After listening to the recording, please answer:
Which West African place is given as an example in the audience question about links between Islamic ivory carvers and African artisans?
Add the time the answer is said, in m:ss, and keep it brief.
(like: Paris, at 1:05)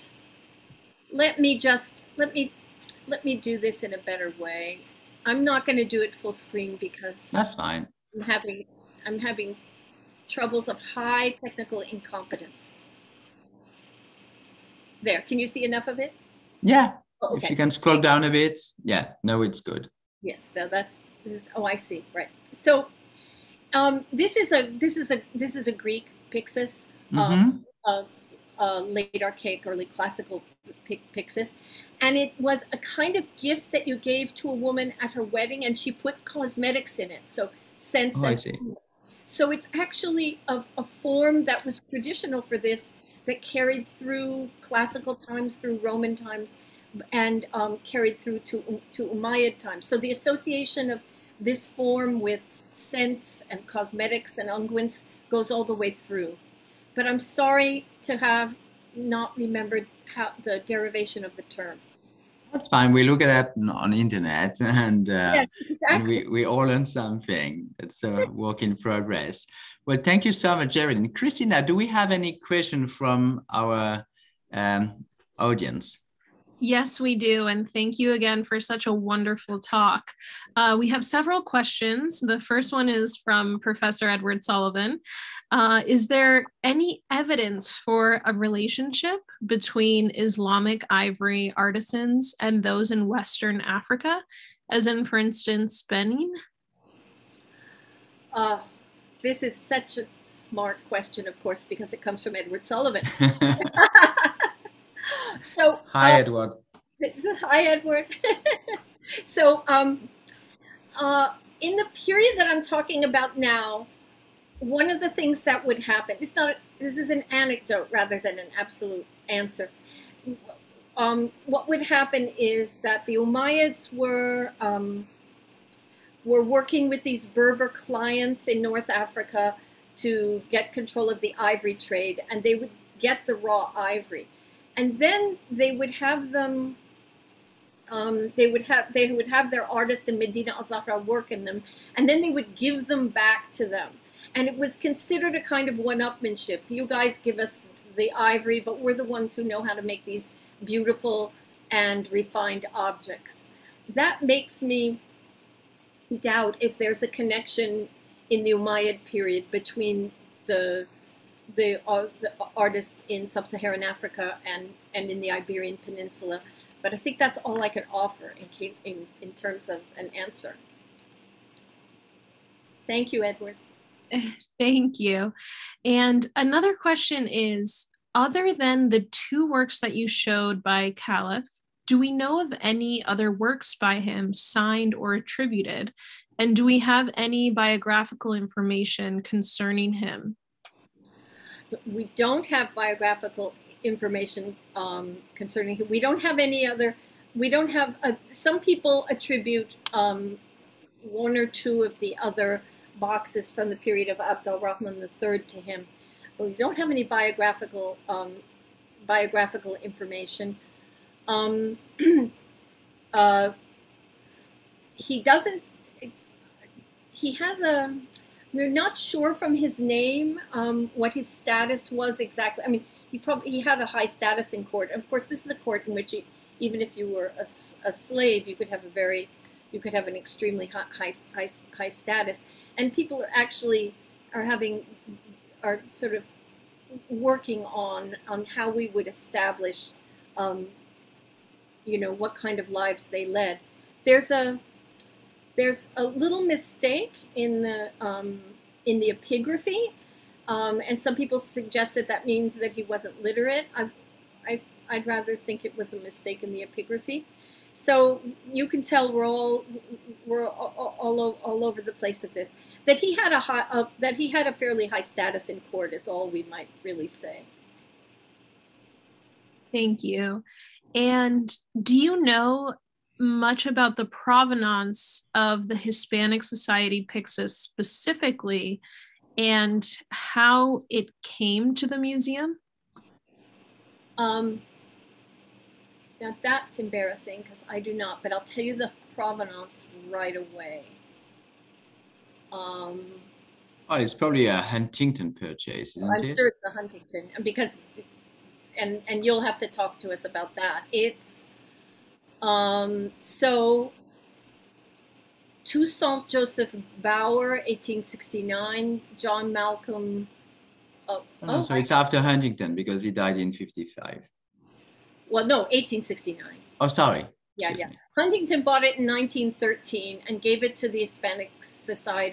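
Benin, at 1:35.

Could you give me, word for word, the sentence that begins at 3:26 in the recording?
But we don't have any biographical um, biographical information.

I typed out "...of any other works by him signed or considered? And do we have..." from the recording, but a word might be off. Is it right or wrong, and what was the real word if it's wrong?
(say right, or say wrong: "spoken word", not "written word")
wrong: "attributed", not "considered".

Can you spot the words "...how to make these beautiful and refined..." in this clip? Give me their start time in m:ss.
2:29.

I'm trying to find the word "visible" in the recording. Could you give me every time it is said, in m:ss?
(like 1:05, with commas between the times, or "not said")
not said.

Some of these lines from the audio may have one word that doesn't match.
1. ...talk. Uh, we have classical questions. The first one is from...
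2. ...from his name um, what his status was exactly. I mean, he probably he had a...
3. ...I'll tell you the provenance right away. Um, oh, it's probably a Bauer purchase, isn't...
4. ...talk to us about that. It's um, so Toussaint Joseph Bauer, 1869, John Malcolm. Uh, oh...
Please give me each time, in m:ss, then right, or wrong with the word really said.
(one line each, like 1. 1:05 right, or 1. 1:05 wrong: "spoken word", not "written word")
1. 1:19 wrong: "several", not "classical"
2. 3:39 right
3. 4:48 wrong: "Huntington", not "Bauer"
4. 4:59 right.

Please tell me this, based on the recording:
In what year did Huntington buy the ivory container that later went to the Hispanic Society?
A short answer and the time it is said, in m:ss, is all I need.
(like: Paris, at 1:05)
1913, at 5:19.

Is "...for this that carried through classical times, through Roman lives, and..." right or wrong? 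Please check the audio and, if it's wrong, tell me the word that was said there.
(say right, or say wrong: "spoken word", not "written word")
wrong: "times", not "lives".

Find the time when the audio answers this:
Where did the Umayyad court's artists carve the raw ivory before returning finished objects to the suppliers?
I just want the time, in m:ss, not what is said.
2:20.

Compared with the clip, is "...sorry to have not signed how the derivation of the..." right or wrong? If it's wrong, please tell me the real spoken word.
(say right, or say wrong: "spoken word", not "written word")
wrong: "remembered", not "signed".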